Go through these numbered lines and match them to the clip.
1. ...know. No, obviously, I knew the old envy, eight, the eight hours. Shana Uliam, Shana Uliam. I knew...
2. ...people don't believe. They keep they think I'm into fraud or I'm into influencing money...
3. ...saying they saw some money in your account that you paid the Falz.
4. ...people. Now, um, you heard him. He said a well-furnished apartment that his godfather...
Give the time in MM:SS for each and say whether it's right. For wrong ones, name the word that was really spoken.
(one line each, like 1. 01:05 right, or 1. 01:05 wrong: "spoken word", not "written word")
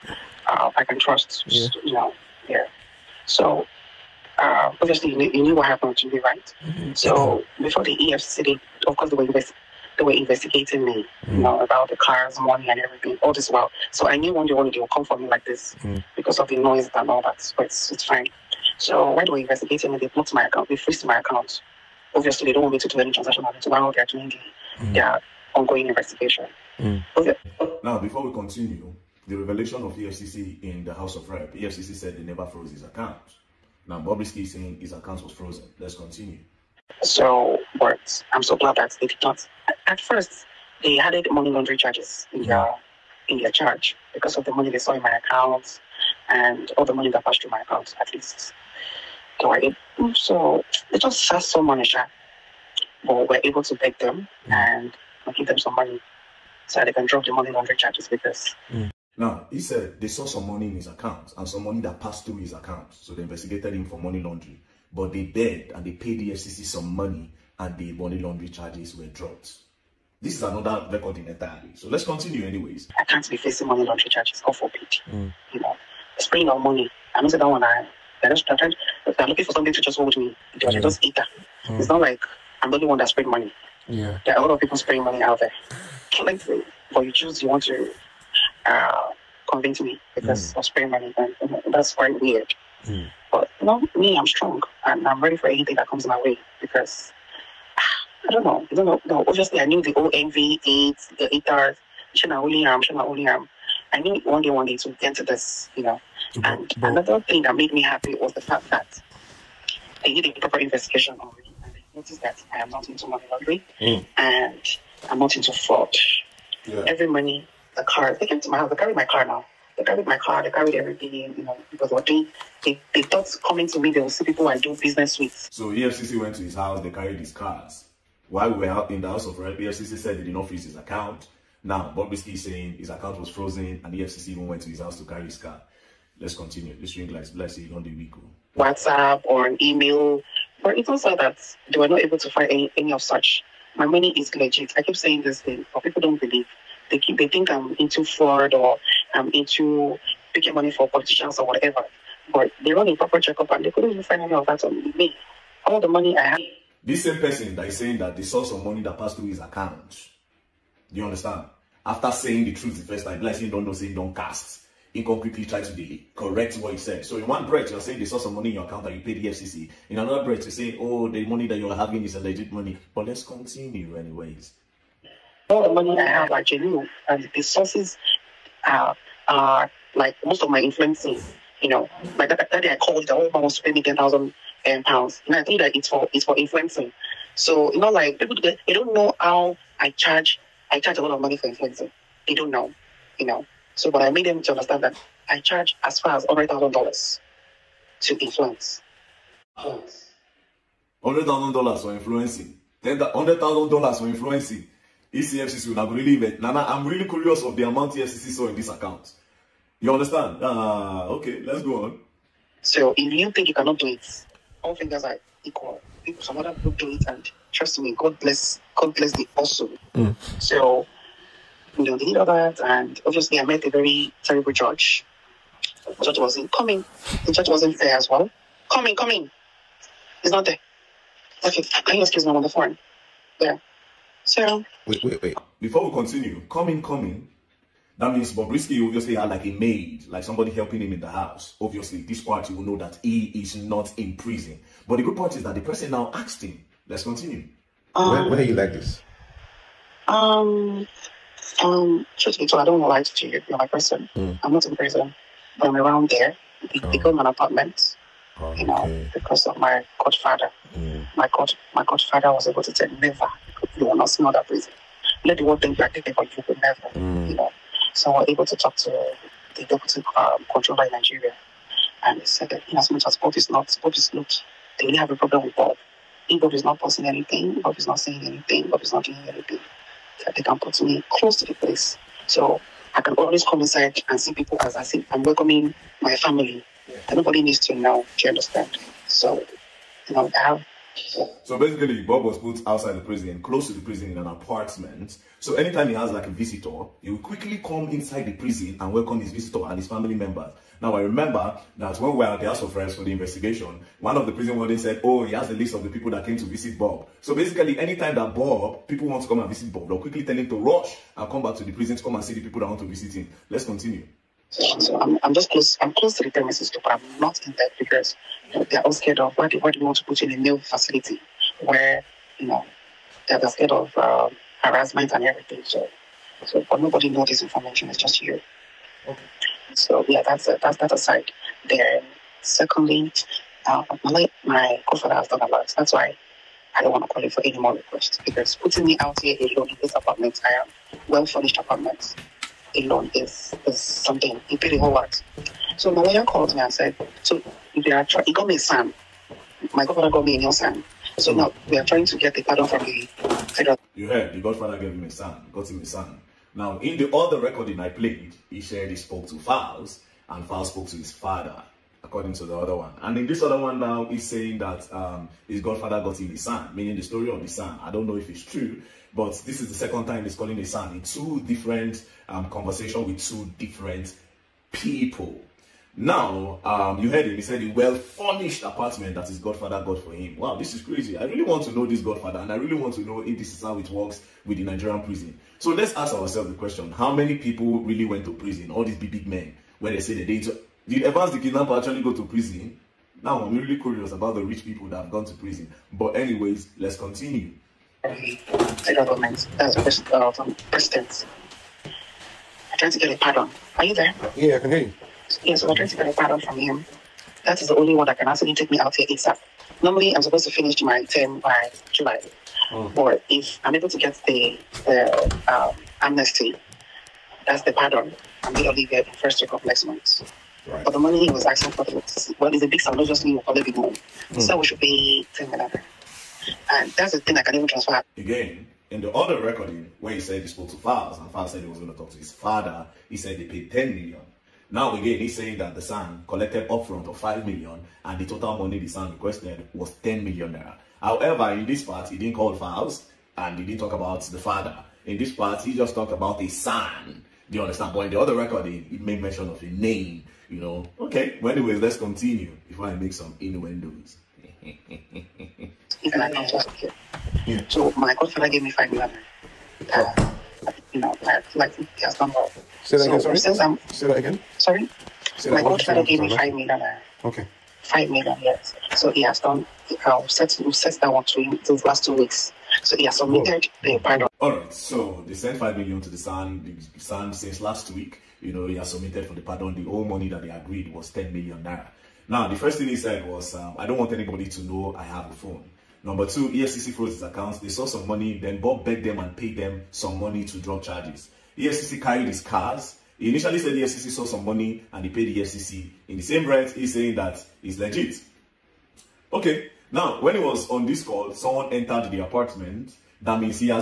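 1. 01:38 right
2. 02:25 wrong: "picking", not "influencing"
3. 02:47 wrong: "EFCC", not "Falz"
4. 06:14 right.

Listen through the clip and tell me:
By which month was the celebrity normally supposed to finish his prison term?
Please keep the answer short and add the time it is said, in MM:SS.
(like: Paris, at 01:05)
July, at 06:51.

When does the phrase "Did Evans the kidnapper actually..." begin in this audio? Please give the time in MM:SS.
06:30.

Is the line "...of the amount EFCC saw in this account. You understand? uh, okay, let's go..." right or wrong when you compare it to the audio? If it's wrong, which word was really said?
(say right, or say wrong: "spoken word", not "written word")
right.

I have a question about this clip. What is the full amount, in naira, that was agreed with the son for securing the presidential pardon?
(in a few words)
10 million naira.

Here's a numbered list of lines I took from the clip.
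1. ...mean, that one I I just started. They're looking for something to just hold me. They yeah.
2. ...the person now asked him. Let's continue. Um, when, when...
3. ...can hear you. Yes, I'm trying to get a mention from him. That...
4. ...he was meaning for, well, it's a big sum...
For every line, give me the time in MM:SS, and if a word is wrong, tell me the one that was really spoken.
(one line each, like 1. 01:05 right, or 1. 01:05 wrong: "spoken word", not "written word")
1. 01:17 right
2. 04:05 right
3. 06:44 wrong: "pardon", not "mention"
4. 07:01 wrong: "asking", not "meaning".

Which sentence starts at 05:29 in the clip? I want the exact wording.
So yeah, that's a, that's that aside.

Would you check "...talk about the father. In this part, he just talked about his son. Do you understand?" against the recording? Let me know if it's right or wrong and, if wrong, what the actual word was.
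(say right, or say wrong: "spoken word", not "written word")
right.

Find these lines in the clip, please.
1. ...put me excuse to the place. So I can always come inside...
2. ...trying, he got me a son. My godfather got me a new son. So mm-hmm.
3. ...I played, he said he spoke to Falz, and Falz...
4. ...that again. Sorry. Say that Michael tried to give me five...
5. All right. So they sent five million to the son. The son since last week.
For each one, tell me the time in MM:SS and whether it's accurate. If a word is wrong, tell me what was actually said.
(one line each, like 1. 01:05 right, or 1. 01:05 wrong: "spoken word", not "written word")
1. 04:40 wrong: "close", not "excuse"
2. 05:48 right
3. 05:57 right
4. 07:44 right
5. 07:54 right.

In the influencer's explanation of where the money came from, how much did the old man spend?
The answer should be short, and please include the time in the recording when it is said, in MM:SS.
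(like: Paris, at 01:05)
10,000 pounds, at 03:03.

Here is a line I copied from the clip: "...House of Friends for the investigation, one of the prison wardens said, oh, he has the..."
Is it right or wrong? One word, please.
right.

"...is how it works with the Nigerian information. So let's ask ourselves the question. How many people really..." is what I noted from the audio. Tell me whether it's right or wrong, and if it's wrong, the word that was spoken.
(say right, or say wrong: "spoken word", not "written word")
wrong: "prison", not "information".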